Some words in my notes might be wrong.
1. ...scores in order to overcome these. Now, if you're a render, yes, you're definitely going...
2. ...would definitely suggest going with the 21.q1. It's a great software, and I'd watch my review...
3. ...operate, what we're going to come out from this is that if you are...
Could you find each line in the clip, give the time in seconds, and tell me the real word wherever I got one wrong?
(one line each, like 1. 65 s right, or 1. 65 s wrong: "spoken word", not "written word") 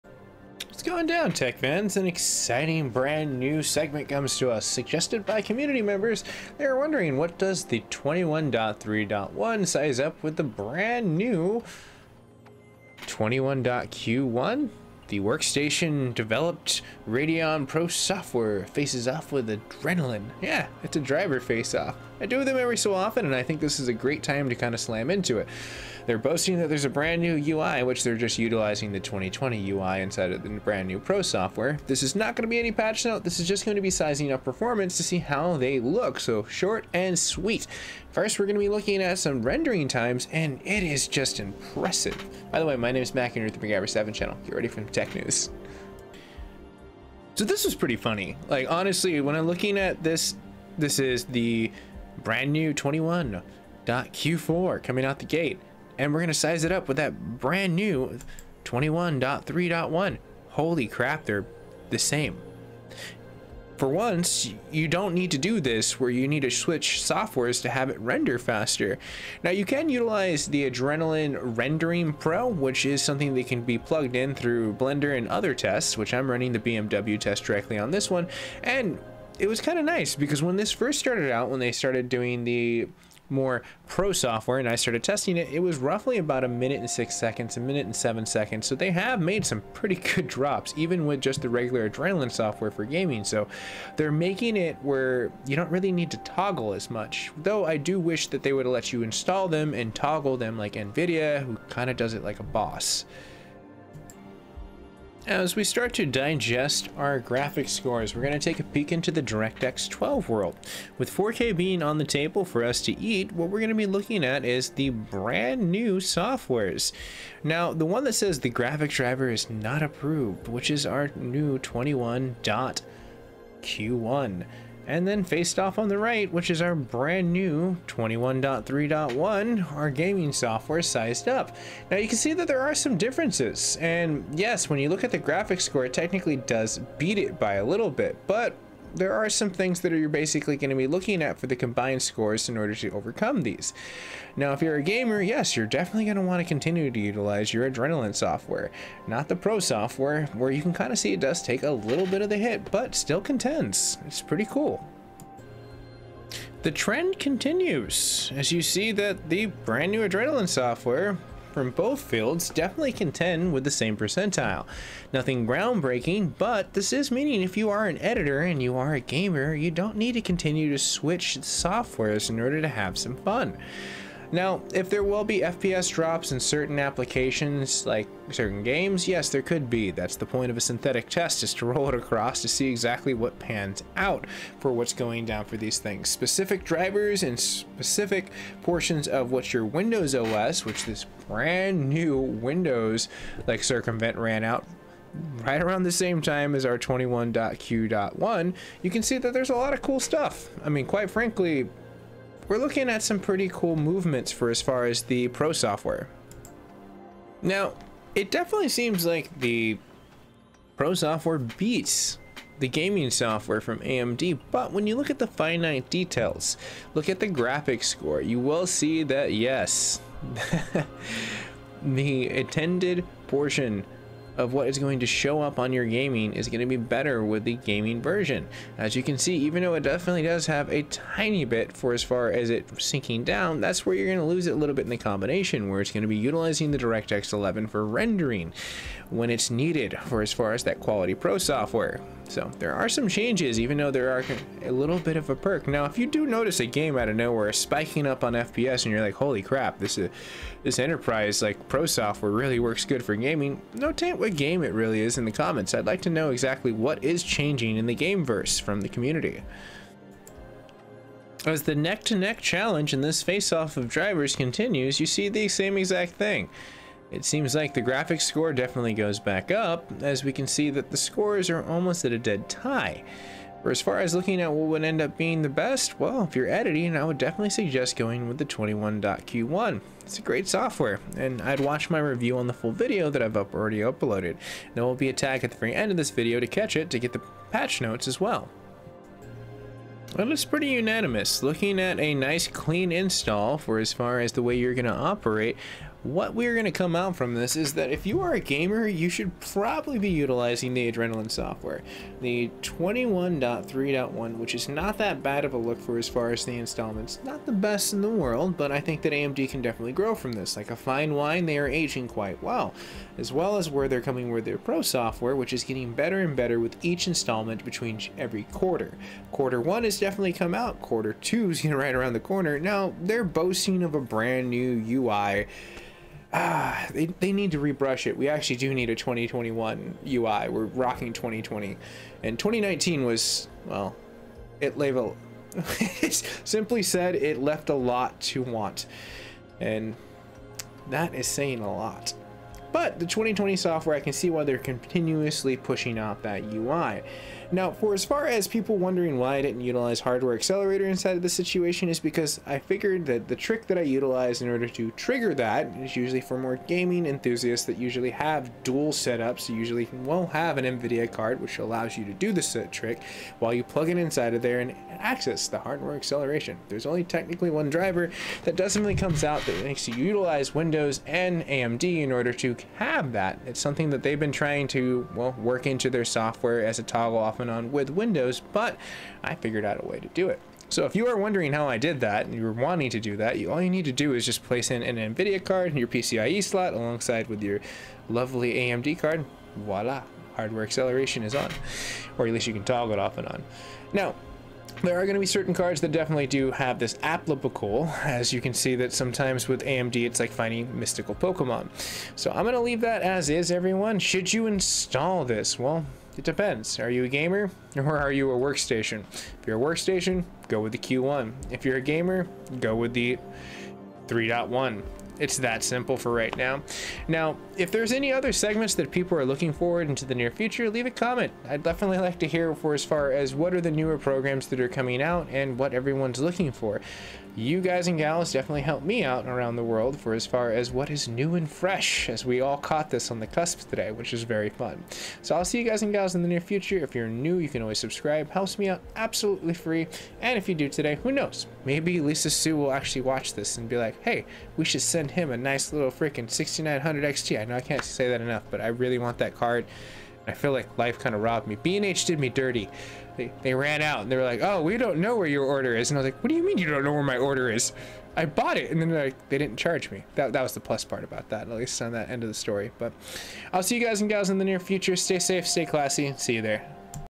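1. 142 s wrong: "gamer", not "render"
2. 277 s right
3. 294 s right.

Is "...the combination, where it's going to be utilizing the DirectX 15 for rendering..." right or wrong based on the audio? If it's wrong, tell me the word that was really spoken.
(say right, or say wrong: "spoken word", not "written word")
wrong: "11", not "15".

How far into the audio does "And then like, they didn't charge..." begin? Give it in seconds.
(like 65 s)
458 s.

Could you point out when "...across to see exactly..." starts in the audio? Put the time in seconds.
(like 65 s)
181 s.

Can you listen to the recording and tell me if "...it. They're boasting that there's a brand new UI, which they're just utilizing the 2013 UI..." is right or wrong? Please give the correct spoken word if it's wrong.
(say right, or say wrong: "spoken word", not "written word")
wrong: "2020", not "2013".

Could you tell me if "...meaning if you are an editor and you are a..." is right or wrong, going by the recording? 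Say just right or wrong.
right.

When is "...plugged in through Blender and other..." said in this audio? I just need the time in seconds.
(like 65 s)
73 s.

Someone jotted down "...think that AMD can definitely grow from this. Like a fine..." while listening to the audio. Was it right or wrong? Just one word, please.
right.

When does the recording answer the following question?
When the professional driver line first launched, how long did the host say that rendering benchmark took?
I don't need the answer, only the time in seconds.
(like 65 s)
86 s.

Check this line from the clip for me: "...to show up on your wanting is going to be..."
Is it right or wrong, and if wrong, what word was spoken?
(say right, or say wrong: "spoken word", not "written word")
wrong: "gaming", not "wanting".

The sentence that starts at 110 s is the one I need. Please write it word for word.
With 4K being on the table for us to eat, what we're going to be looking at is the brand new softwares.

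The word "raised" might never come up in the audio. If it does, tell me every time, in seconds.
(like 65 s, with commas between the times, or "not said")
not said.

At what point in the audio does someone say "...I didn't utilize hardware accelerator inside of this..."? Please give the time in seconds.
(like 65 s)
349 s.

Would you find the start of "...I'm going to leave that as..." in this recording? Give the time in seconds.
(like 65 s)
402 s.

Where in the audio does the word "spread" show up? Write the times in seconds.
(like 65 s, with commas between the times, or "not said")
not said.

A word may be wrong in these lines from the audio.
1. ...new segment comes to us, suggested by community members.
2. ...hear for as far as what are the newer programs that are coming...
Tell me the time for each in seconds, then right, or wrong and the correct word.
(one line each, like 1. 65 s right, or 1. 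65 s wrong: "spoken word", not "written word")
1. 3 s right
2. 422 s right.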